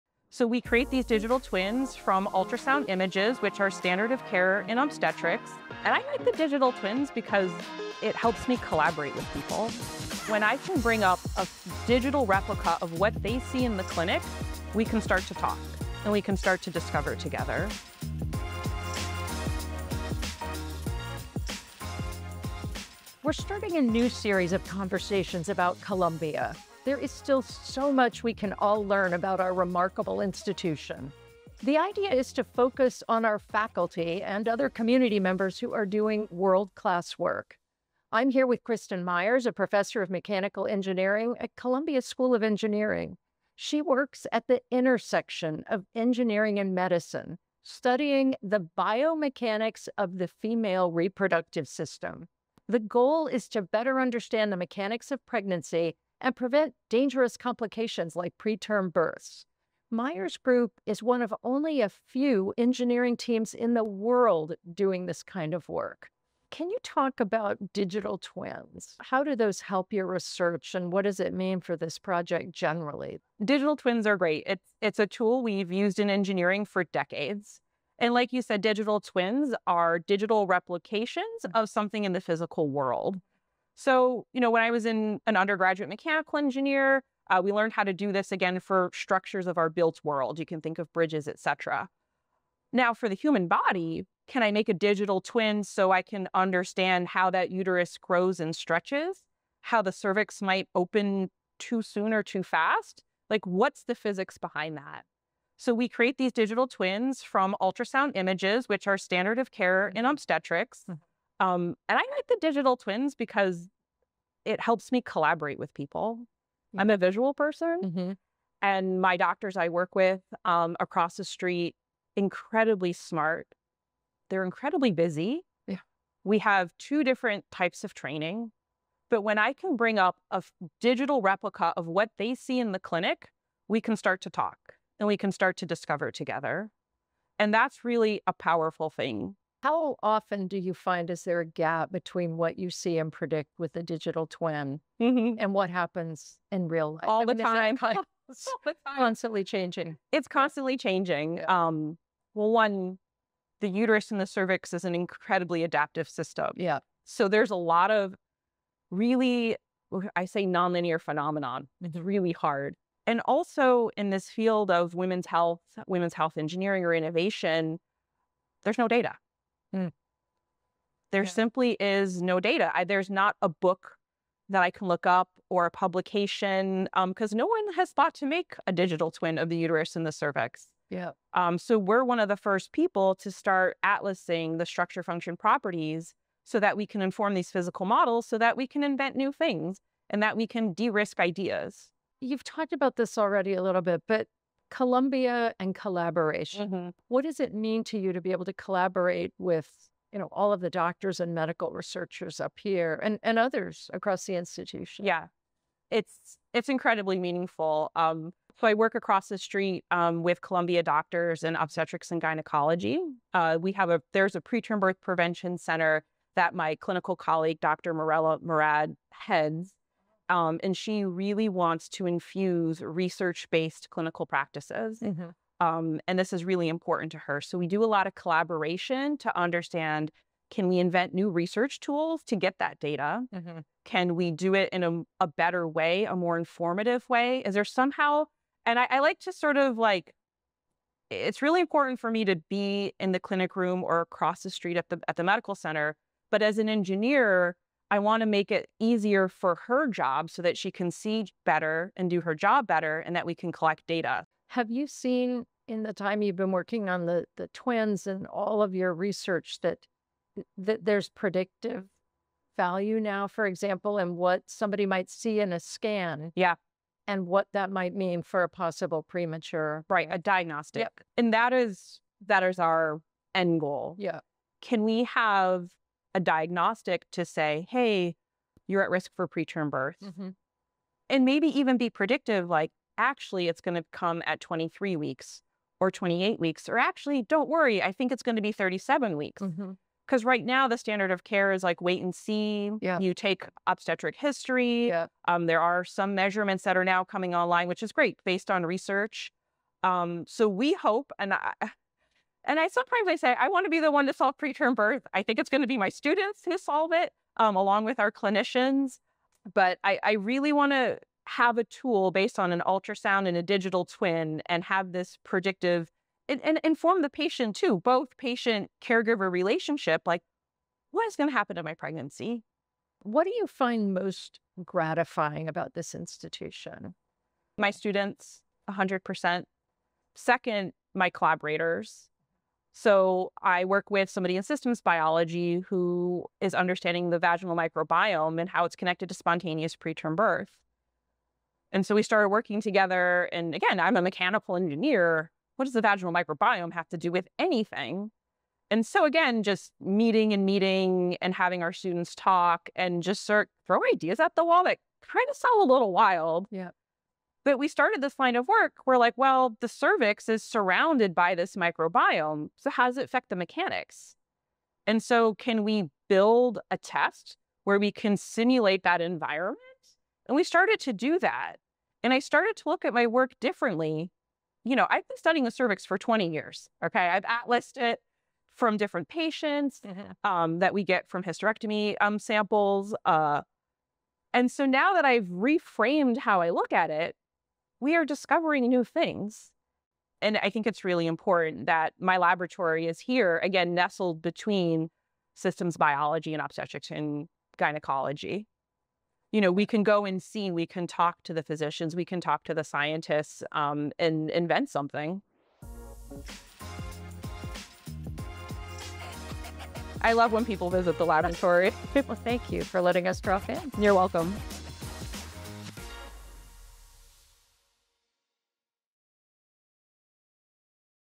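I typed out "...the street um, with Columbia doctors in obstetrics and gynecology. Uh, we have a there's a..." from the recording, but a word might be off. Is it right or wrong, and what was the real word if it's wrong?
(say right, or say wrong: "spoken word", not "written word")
right.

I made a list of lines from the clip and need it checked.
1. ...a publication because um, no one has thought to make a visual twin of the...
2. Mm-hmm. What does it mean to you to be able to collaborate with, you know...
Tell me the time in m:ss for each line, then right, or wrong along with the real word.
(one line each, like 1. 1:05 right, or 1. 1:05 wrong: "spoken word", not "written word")
1. 2:55 wrong: "digital", not "visual"
2. 3:16 right.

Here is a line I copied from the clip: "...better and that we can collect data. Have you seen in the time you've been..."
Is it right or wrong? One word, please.
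right.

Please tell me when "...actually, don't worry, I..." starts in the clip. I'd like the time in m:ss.
4:46.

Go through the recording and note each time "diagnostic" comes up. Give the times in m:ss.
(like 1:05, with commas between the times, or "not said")
4:30, 4:36.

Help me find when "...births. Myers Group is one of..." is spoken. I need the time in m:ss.
0:58.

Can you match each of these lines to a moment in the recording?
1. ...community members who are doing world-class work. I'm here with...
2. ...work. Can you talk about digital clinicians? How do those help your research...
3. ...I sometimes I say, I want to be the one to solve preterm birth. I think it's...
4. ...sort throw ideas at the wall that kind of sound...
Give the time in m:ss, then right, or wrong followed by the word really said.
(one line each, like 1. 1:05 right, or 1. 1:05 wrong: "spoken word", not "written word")
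1. 0:34 right
2. 1:05 wrong: "twins", not "clinicians"
3. 5:02 right
4. 5:53 right.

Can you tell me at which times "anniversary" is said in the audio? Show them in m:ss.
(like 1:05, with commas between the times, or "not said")
not said.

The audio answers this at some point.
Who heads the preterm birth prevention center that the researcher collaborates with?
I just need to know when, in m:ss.
3:37.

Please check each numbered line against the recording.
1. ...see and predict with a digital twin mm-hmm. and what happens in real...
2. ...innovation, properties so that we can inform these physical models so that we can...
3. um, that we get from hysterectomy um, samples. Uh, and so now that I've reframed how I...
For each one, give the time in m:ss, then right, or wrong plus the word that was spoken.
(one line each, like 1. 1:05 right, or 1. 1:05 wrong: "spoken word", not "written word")
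1. 2:22 right
2. 3:05 wrong: "function", not "innovation"
3. 6:20 right.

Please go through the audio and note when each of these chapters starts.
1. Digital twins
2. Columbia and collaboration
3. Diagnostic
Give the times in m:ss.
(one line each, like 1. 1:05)
1. 1:18
2. 3:30
3. 4:30.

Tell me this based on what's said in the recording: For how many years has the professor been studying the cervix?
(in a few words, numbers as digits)
20 years.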